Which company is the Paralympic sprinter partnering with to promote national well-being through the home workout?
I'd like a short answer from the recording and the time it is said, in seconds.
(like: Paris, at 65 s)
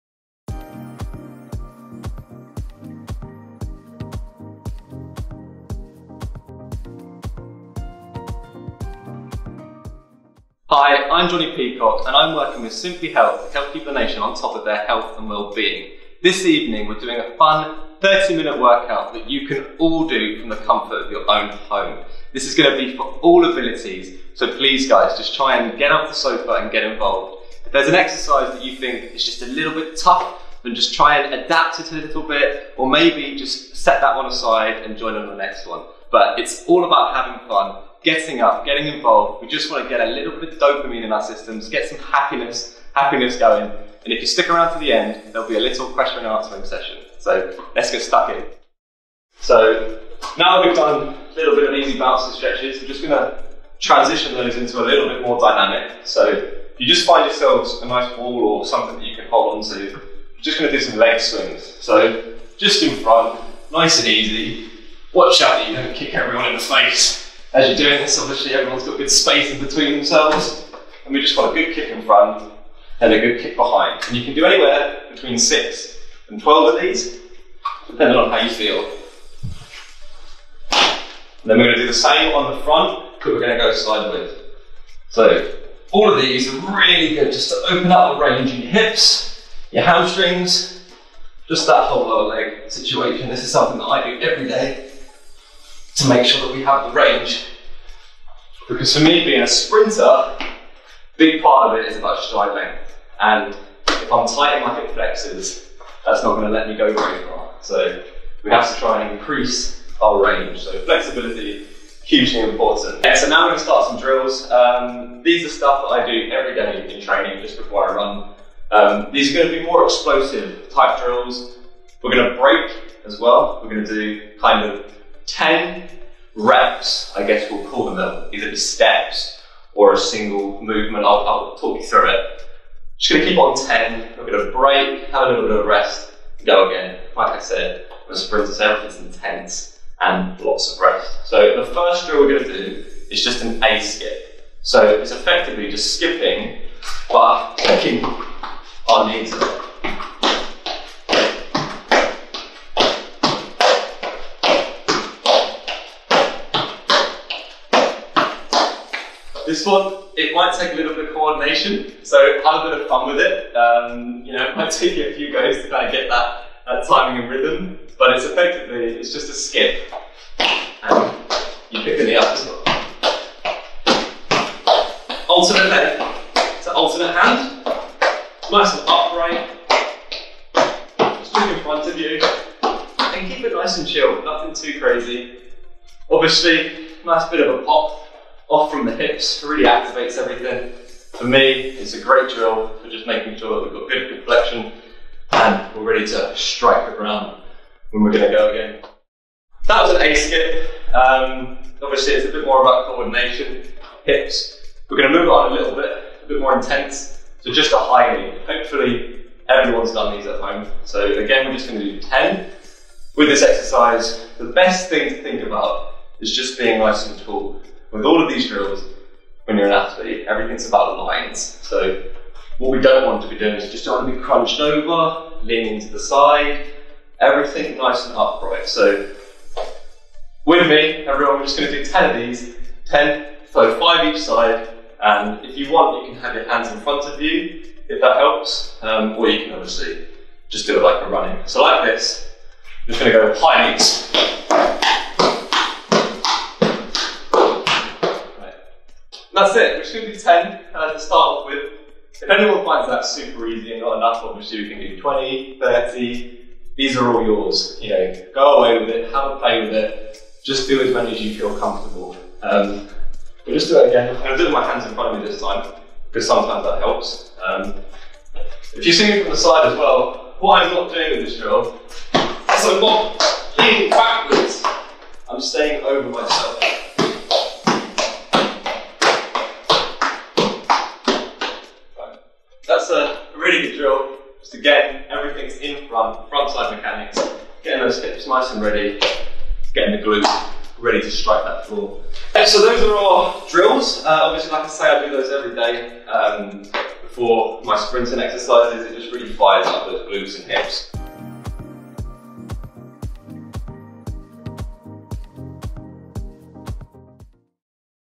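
Simplyhealth, at 12 s.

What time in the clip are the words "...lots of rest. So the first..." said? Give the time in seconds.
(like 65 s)
140 s.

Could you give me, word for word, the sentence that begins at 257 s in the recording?
You know, go away with it, have a play with it, just do as many as you feel comfortable.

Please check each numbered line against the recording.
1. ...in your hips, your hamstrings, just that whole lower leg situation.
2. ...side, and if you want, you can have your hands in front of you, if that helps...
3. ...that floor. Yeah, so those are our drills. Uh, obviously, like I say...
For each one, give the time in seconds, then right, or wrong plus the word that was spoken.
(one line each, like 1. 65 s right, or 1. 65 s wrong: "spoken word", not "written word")
1. 88 s right
2. 234 s right
3. 291 s right.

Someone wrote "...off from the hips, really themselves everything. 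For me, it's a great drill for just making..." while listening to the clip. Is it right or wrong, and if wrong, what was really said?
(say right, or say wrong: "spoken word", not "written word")
wrong: "activates", not "themselves".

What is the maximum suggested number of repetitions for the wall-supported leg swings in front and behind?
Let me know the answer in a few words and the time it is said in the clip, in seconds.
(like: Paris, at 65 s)
12, at 76 s.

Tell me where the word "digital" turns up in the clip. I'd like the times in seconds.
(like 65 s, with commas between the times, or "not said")
not said.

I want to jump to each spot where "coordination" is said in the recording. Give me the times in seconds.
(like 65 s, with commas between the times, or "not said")
161 s, 202 s.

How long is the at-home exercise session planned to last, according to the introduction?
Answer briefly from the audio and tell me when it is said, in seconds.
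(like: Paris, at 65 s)
30 minutes, at 17 s.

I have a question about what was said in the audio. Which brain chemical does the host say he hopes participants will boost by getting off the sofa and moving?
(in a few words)
dopamine.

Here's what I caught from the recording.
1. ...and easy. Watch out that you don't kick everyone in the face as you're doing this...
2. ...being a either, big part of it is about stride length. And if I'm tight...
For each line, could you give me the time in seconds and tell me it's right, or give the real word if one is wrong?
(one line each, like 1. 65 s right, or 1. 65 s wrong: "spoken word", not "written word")
1. 63 s right
2. 99 s wrong: "sprinter", not "either".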